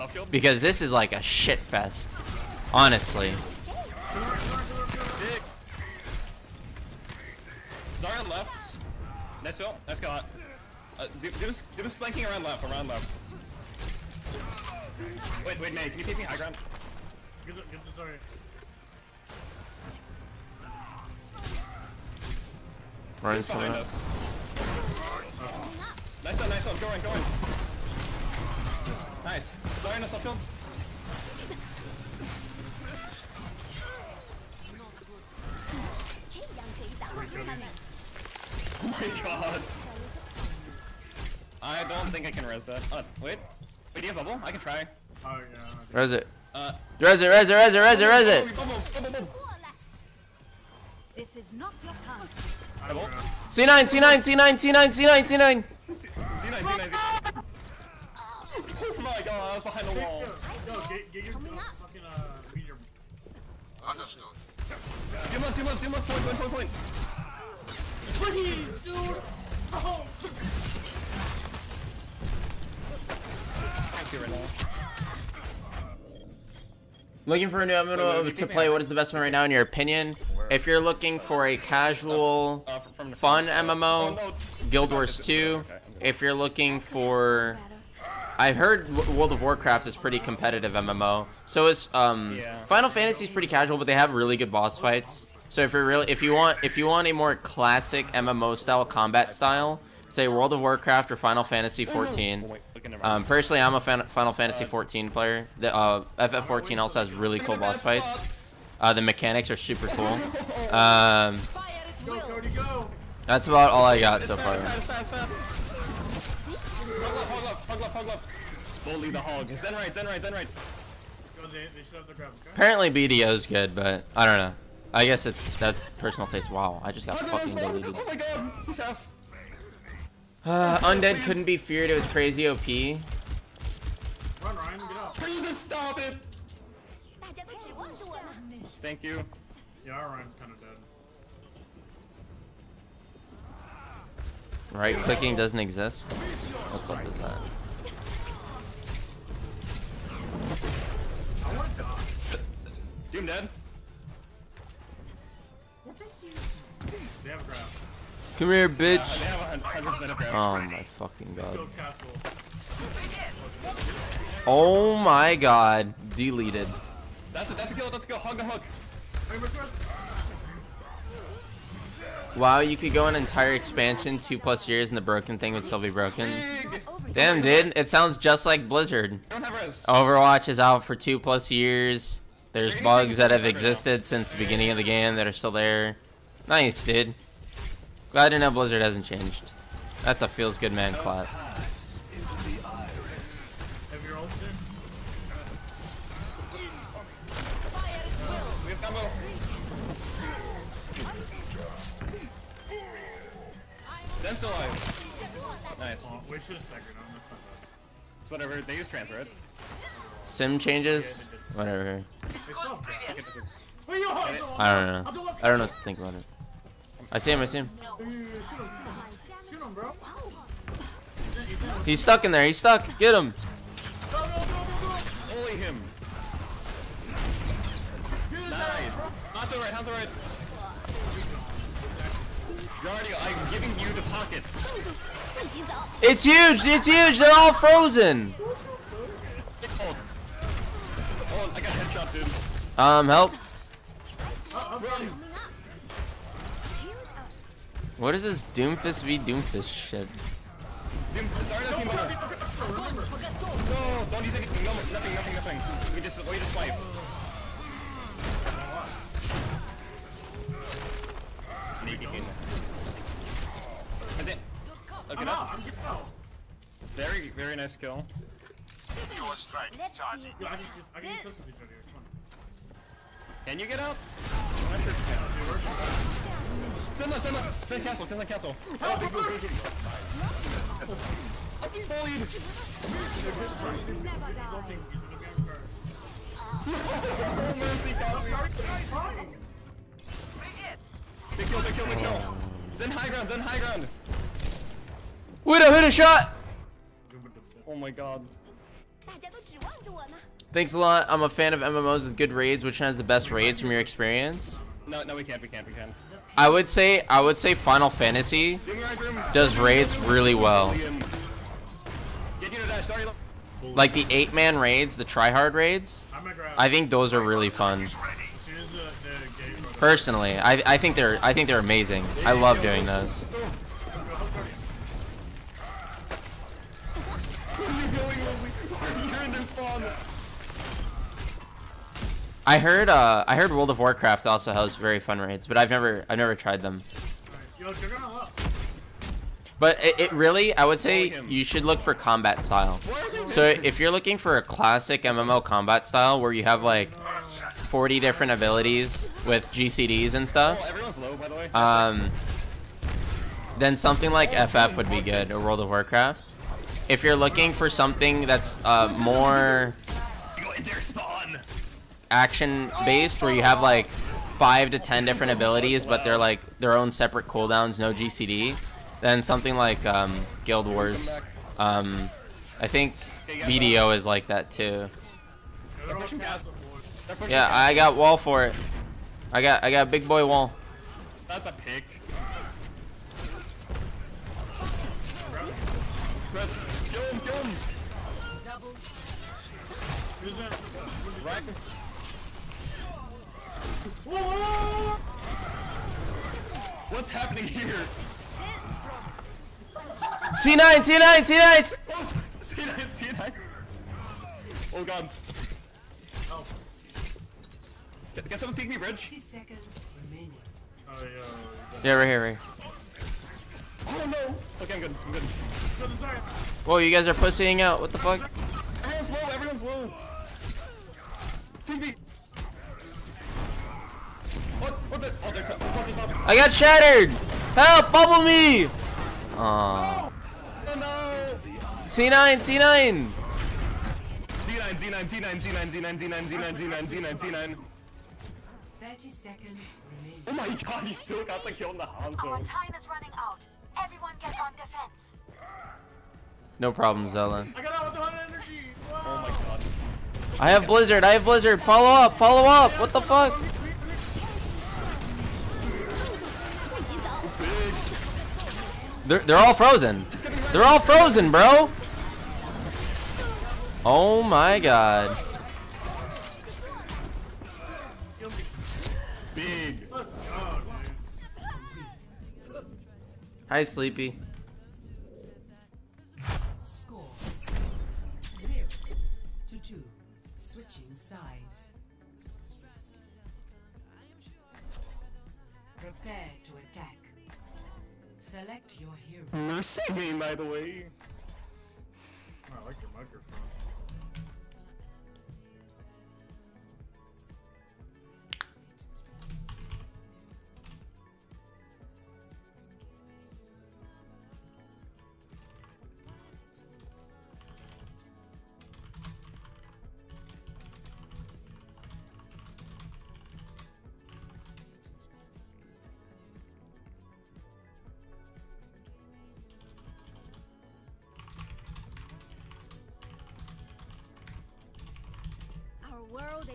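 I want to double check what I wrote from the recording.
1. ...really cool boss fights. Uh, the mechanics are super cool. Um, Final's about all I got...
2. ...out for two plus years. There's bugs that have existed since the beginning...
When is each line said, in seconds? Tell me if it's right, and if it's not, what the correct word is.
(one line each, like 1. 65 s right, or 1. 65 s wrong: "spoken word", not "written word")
1. 107 s wrong: "That", not "Final"
2. 180 s right.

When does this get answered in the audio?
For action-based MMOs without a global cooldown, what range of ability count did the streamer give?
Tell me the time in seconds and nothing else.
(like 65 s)
364 s.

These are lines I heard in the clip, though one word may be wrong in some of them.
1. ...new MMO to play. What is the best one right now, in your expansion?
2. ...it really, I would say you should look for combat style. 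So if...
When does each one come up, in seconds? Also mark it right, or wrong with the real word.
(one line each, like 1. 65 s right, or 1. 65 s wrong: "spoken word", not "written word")
1. 77 s wrong: "opinion", not "expansion"
2. 339 s right.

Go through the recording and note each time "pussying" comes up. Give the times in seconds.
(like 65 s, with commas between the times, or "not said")
417 s.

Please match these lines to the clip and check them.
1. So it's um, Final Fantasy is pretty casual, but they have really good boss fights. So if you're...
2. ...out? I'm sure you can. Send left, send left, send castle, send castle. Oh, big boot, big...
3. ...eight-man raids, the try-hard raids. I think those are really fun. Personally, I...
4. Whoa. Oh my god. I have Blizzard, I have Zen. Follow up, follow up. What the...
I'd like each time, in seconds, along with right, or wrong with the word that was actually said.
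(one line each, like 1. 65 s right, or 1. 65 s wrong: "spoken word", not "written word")
1. 91 s right
2. 273 s right
3. 314 s right
4. 448 s wrong: "Blizzard", not "Zen".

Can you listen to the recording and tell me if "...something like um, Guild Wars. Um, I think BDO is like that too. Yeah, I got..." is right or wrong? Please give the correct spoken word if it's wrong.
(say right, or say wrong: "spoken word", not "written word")
right.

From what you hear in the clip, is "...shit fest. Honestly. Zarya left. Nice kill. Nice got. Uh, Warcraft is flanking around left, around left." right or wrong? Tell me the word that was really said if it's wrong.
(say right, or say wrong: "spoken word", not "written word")
wrong: "Doom", not "Warcraft".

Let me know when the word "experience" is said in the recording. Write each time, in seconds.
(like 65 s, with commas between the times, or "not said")
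303 s.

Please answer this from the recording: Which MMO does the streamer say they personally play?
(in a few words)
Final Fantasy 14.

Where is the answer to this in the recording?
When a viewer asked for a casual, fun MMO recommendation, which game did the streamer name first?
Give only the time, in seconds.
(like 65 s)
84 s.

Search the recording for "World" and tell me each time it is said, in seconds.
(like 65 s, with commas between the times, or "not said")
89 s, 100 s, 333 s, 355 s.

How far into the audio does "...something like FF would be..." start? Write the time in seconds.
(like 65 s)
353 s.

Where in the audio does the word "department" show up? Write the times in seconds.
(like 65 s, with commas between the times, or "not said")
not said.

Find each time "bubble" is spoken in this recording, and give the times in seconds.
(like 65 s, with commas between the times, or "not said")
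44 s, 427 s.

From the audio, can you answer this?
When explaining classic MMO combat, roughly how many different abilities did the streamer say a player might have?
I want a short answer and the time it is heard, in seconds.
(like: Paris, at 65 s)
40, at 346 s.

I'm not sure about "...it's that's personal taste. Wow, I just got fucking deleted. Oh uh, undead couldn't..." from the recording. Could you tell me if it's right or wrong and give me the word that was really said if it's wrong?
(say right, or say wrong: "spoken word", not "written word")
right.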